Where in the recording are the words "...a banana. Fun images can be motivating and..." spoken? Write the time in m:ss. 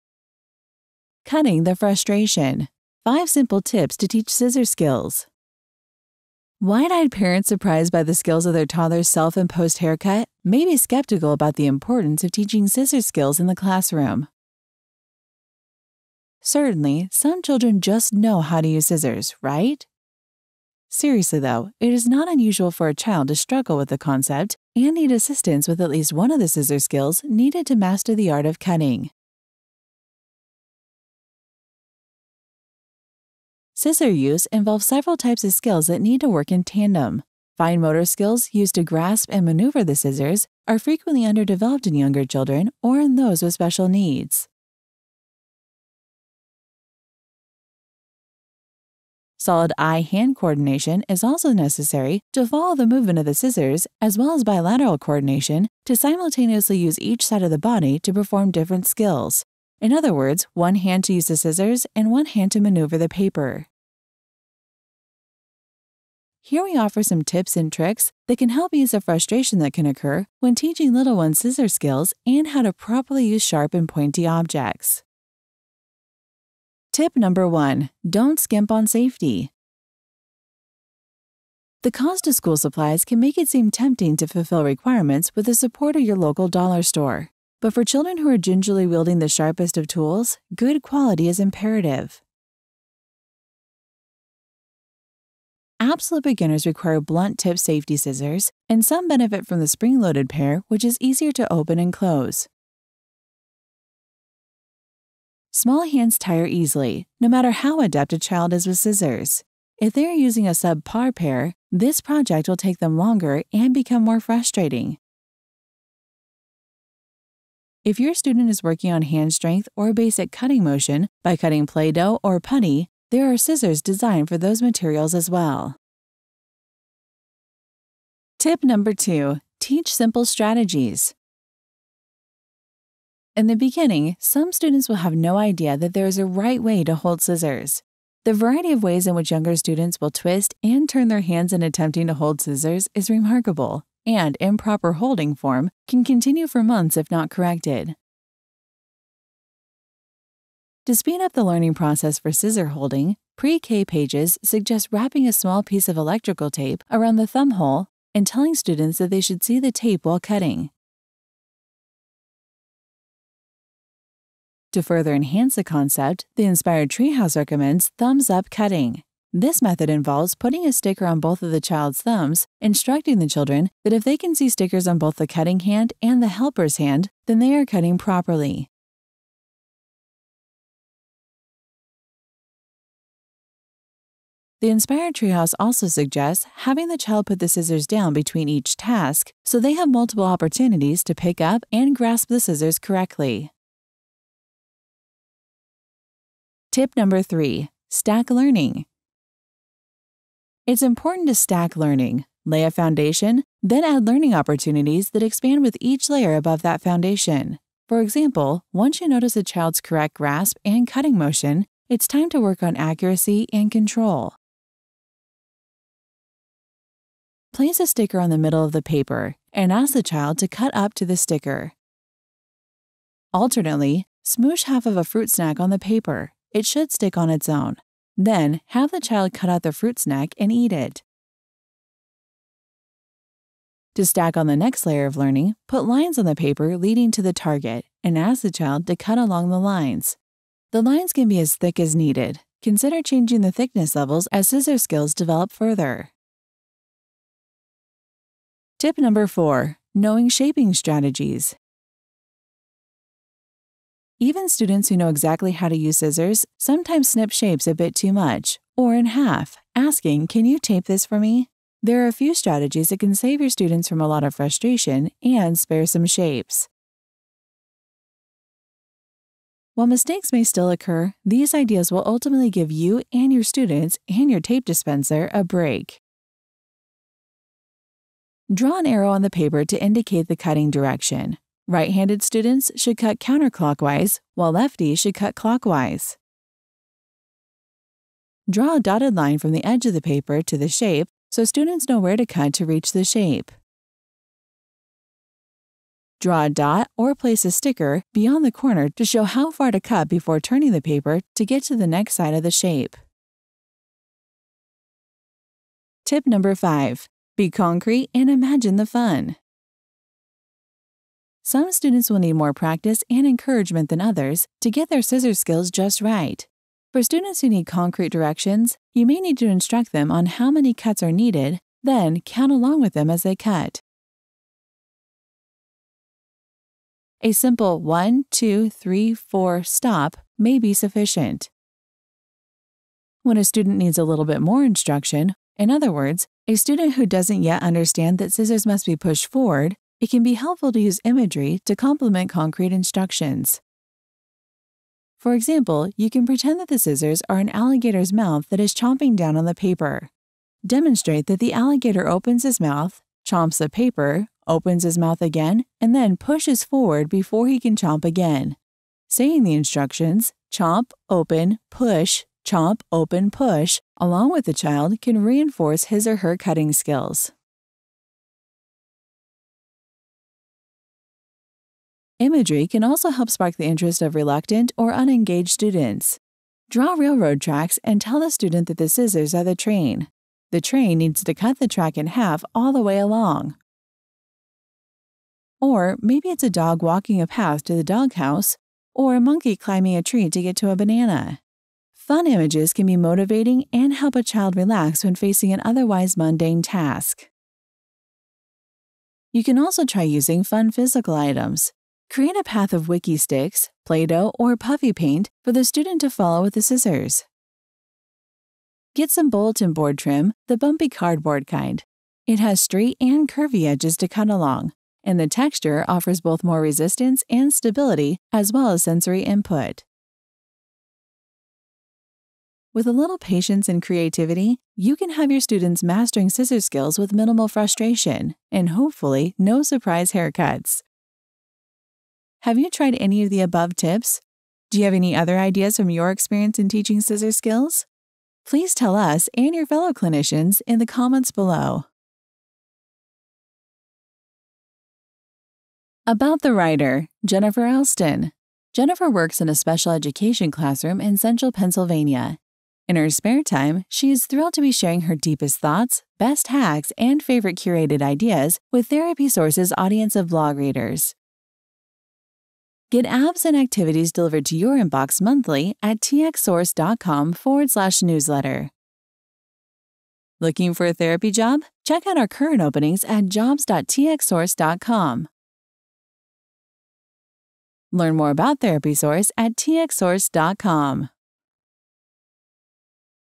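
6:30.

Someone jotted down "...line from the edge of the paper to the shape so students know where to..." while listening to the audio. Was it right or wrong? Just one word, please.
right.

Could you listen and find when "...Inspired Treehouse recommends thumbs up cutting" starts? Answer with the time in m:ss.
2:46.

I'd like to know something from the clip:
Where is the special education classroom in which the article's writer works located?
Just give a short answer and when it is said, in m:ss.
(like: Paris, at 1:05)
central Pennsylvania, at 7:31.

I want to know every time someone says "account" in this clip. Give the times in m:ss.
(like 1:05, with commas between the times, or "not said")
not said.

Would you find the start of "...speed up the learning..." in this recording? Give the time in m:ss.
2:30.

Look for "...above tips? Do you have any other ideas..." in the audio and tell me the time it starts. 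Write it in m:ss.
7:13.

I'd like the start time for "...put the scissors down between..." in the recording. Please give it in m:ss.
3:07.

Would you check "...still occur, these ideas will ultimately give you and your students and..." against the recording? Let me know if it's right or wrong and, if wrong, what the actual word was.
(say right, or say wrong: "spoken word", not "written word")
right.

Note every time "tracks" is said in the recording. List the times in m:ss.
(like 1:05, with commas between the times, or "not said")
6:17, 6:21.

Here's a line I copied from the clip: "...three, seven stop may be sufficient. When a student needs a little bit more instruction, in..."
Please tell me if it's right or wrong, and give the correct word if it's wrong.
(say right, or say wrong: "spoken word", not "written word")
wrong: "four", not "seven".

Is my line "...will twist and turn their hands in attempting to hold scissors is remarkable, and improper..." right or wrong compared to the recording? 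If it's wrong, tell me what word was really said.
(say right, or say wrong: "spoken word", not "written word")
right.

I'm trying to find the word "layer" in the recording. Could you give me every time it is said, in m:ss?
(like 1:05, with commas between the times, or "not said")
3:26, 3:54.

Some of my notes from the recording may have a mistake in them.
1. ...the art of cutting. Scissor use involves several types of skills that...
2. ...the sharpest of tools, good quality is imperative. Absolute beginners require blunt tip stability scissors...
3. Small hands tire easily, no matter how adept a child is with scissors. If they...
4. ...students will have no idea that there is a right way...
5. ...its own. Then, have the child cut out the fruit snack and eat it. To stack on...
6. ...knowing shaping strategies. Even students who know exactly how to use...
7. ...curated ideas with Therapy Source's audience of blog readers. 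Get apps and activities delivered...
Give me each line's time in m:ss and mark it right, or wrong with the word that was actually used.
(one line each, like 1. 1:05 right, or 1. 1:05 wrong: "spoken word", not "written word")
1. 0:28 right
2. 1:29 wrong: "safety", not "stability"
3. 1:45 right
4. 2:14 right
5. 3:47 right
6. 4:09 right
7. 7:37 right.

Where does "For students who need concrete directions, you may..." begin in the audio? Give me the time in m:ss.
5:16.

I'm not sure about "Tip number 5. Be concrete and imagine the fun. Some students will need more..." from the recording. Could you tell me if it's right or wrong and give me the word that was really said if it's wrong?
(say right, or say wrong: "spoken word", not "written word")
right.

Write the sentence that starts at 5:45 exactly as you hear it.
For example, you can pretend that the scissors are an alligator's mouth that is chomping down on the paper.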